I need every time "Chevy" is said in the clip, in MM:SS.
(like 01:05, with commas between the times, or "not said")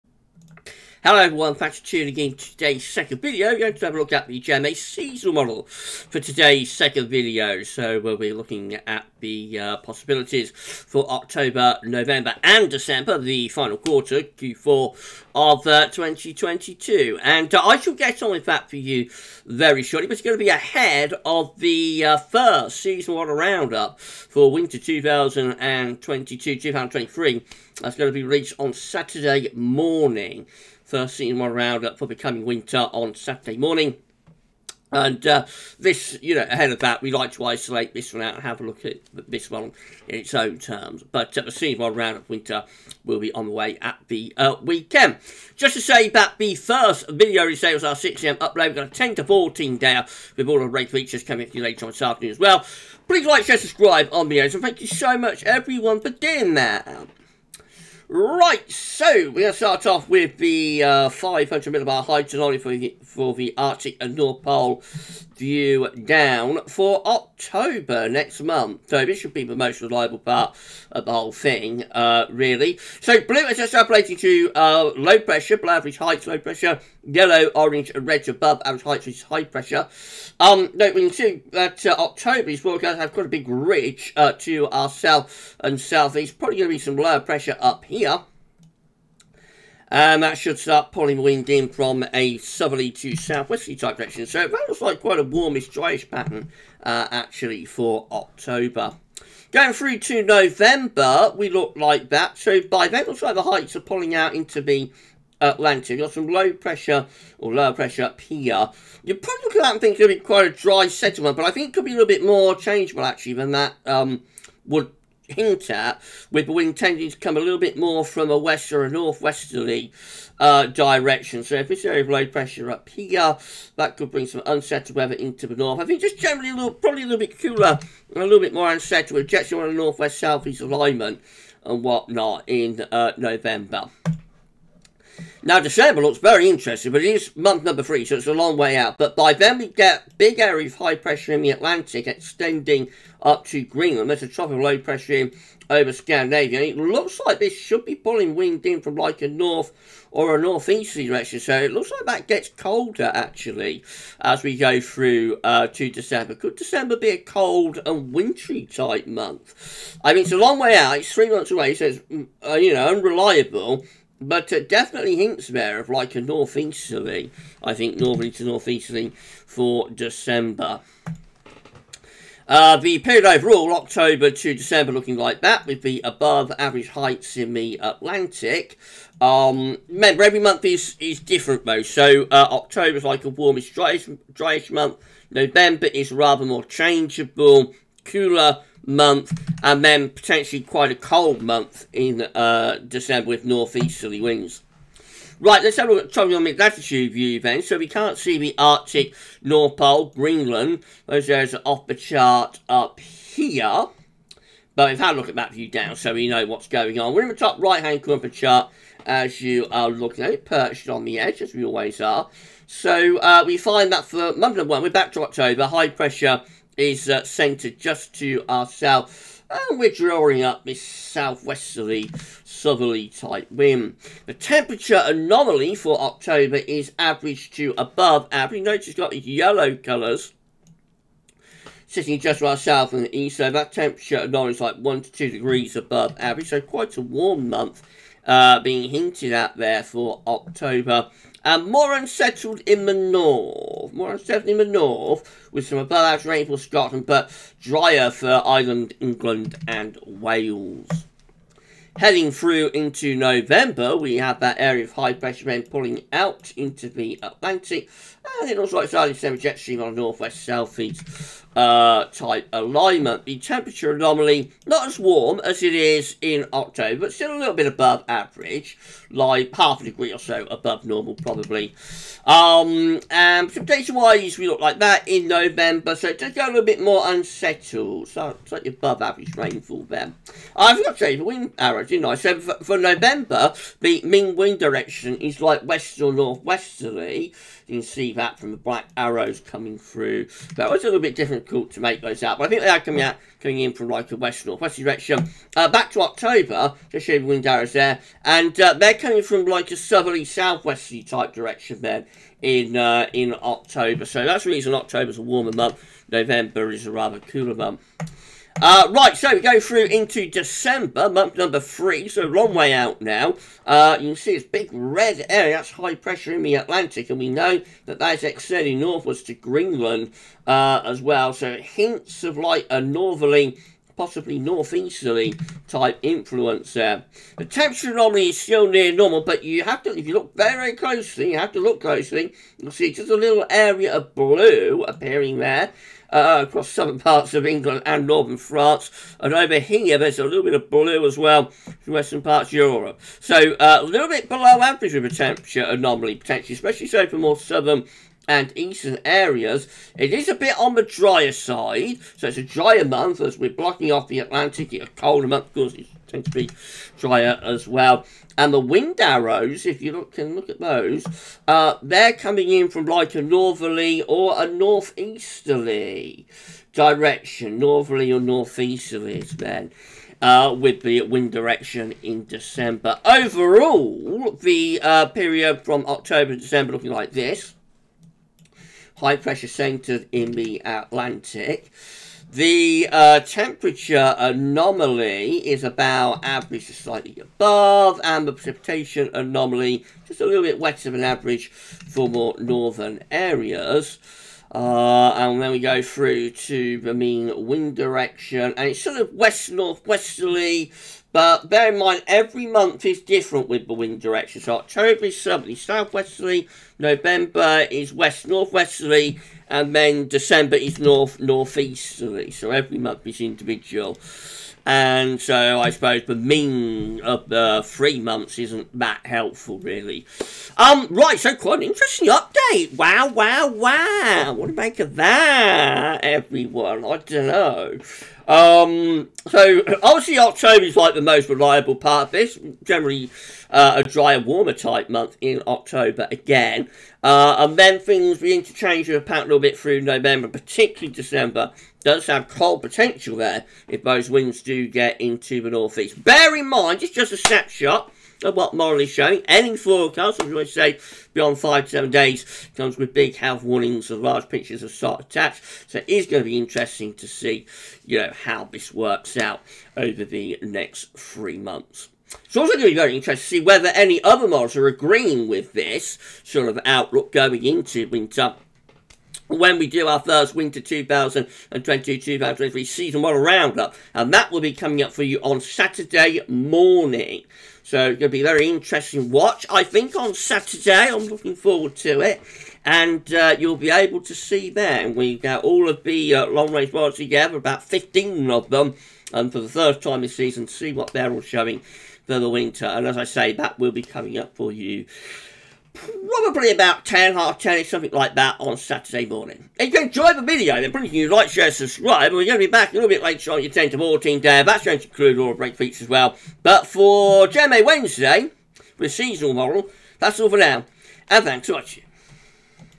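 not said.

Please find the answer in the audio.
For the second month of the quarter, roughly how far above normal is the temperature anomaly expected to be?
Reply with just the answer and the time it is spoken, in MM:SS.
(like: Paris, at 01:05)
Half a degree, at 04:29.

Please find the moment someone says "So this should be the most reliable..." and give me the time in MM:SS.
01:08.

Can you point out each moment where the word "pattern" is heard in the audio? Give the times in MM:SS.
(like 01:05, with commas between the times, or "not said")
01:36, 07:19.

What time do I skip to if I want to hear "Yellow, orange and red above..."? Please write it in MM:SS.
01:17.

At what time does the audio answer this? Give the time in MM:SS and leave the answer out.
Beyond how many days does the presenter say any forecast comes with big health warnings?
07:31.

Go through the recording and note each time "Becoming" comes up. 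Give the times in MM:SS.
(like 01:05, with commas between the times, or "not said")
00:32.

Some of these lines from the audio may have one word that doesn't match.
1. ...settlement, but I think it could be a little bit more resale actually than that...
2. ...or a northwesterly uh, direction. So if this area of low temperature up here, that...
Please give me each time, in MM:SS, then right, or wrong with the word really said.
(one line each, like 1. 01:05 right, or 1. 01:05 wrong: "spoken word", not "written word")
1. 01:50 wrong: "changeable", not "resale"
2. 01:58 wrong: "pressure", not "temperature".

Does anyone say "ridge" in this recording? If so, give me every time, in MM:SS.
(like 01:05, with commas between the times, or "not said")
01:23.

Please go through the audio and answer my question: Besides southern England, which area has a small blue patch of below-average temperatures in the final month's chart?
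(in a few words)
Northern France.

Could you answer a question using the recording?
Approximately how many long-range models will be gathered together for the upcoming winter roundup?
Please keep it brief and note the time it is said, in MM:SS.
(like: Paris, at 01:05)
15, at 08:07.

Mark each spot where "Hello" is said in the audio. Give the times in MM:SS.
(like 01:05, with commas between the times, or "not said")
00:01.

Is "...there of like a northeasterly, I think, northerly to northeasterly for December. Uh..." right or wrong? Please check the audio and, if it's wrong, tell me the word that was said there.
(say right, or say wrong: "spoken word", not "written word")
right.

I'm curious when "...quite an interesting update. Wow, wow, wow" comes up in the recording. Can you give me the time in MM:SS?
07:01.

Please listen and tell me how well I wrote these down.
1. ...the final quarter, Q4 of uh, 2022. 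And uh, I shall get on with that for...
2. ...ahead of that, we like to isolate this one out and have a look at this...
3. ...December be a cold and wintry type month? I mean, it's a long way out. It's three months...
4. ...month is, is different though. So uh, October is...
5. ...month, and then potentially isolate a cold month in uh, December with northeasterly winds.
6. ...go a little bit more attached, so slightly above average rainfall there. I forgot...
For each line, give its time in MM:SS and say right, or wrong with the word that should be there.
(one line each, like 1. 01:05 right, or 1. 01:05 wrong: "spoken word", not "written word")
1. 00:13 right
2. 00:36 right
3. 02:36 right
4. 03:00 right
5. 03:08 wrong: "quite", not "isolate"
6. 04:36 wrong: "unsettled", not "attached".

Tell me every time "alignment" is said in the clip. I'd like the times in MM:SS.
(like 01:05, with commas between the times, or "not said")
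02:10, 04:22.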